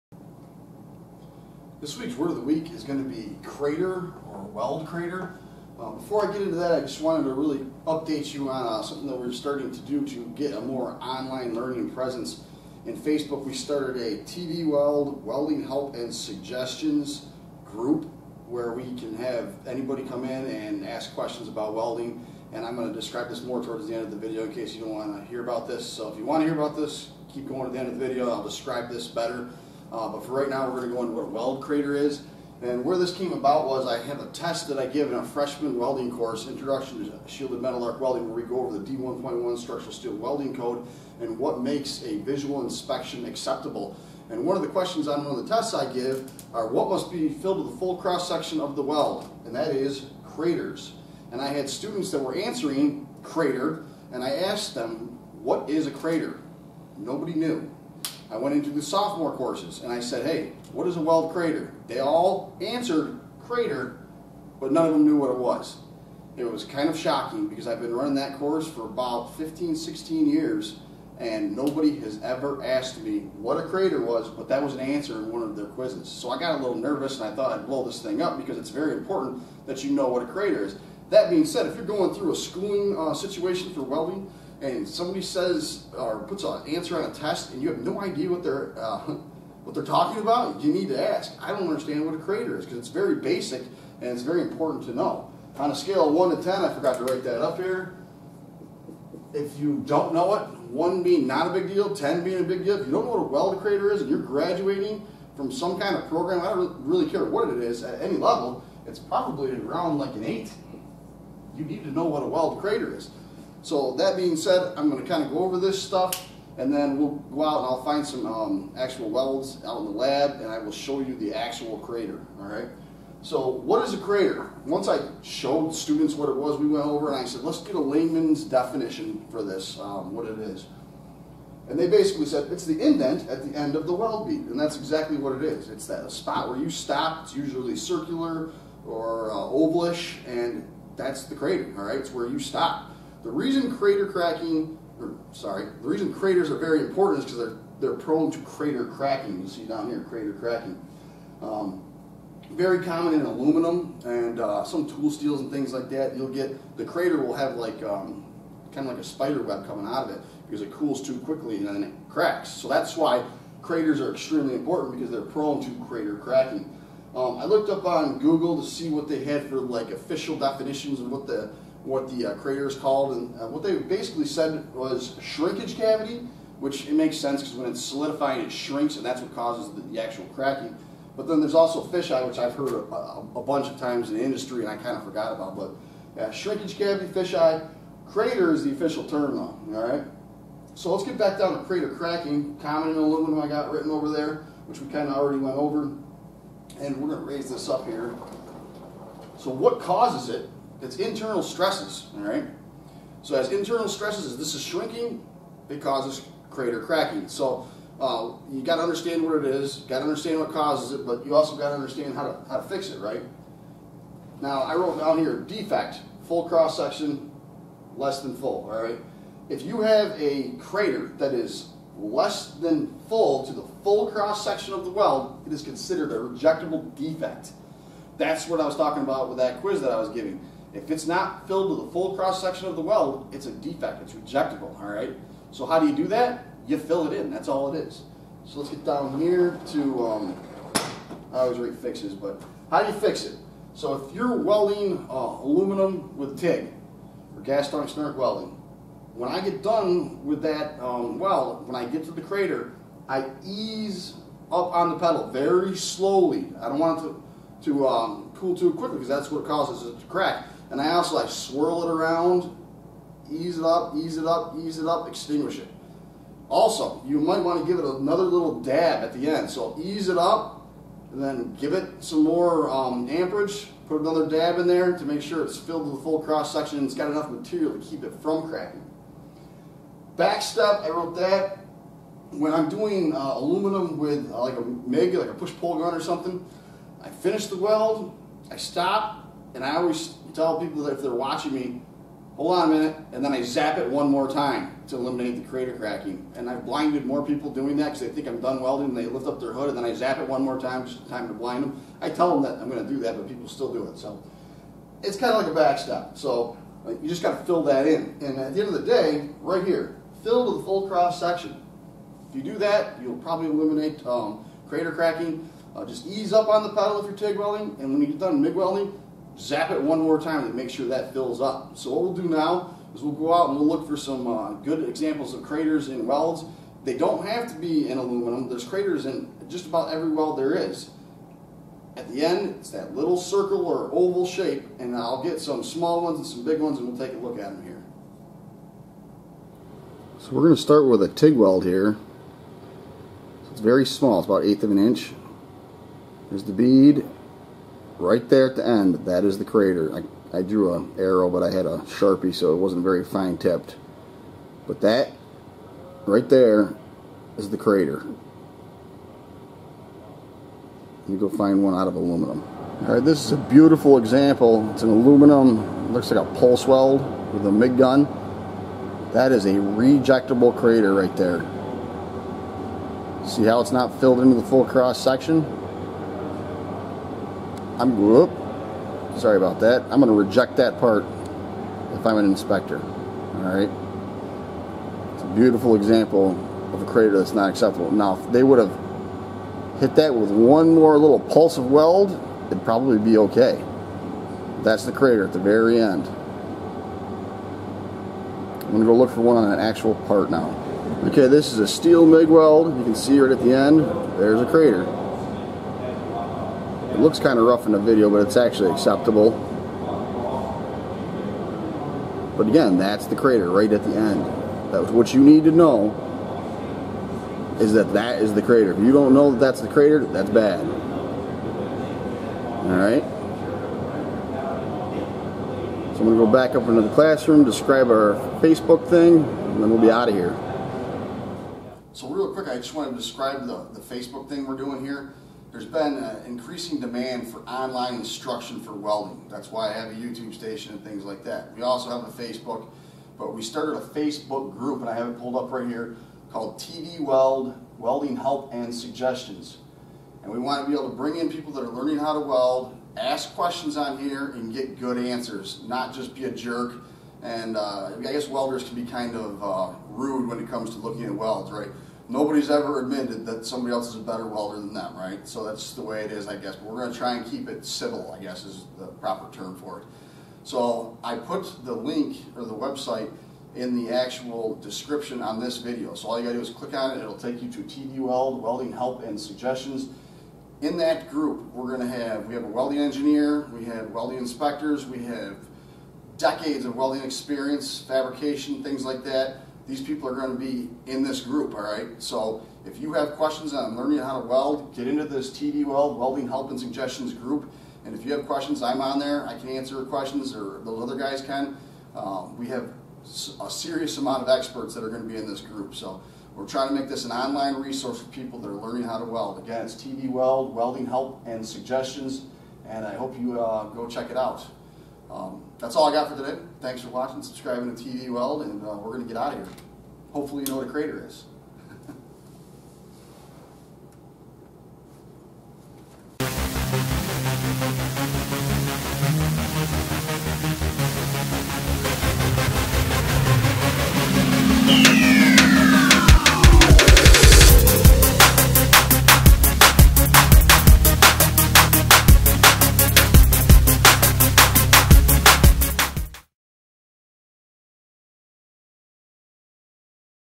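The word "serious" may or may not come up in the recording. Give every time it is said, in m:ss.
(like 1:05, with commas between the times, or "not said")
8:23.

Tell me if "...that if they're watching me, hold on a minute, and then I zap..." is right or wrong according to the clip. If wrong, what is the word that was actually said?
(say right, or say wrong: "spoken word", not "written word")
right.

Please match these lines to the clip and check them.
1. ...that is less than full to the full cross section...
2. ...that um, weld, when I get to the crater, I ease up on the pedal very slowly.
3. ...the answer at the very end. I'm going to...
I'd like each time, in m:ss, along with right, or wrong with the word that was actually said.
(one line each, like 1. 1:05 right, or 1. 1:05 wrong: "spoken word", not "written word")
1. 3:41 right
2. 4:10 right
3. 6:34 wrong: "crater", not "answer".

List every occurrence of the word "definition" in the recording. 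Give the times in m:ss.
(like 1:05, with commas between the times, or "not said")
2:08, 2:50.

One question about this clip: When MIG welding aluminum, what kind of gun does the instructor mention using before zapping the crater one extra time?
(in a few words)
Push-pull gun.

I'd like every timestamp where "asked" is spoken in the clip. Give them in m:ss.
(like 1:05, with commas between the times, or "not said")
0:54, 1:12.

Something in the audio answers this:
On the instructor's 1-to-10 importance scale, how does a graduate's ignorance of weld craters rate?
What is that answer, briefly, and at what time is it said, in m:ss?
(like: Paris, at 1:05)
8, at 1:49.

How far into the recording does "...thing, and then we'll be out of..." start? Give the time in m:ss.
7:08.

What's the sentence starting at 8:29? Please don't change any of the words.
Again, it's TV Weld, Welding Help and Suggestions, and I hope you uh, go check it out.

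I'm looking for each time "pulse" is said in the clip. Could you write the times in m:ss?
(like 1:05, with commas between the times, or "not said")
6:06, 6:31.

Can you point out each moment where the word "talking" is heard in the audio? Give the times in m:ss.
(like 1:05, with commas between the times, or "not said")
1:29, 3:48.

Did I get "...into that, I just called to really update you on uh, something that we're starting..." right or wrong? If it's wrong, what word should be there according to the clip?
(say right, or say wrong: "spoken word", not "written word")
wrong: "wanted", not "called".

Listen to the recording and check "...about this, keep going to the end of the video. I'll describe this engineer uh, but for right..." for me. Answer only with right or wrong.
wrong.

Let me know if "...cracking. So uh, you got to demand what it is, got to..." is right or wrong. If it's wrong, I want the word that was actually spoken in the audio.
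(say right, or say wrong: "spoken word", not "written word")
wrong: "understand", not "demand".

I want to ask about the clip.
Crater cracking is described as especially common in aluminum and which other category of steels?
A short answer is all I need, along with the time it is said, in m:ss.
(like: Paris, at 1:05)
Tool steels, at 2:34.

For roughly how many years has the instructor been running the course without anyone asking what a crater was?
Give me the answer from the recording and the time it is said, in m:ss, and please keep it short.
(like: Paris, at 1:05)
15 to 16 years, at 1:08.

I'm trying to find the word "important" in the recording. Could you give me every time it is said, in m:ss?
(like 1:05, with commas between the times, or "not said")
1:18, 1:34, 2:26, 2:44.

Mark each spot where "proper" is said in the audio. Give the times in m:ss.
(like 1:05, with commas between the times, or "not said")
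7:48.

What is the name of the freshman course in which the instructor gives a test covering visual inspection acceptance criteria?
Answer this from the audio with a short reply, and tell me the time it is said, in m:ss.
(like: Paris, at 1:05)
Introduction to Shielded Metal Arc Welding, at 0:36.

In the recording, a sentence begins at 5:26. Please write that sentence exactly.
They don't have to be in aluminum.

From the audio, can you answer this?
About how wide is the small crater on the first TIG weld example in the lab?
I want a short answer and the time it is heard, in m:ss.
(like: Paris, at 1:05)
1/8 inch, at 5:44.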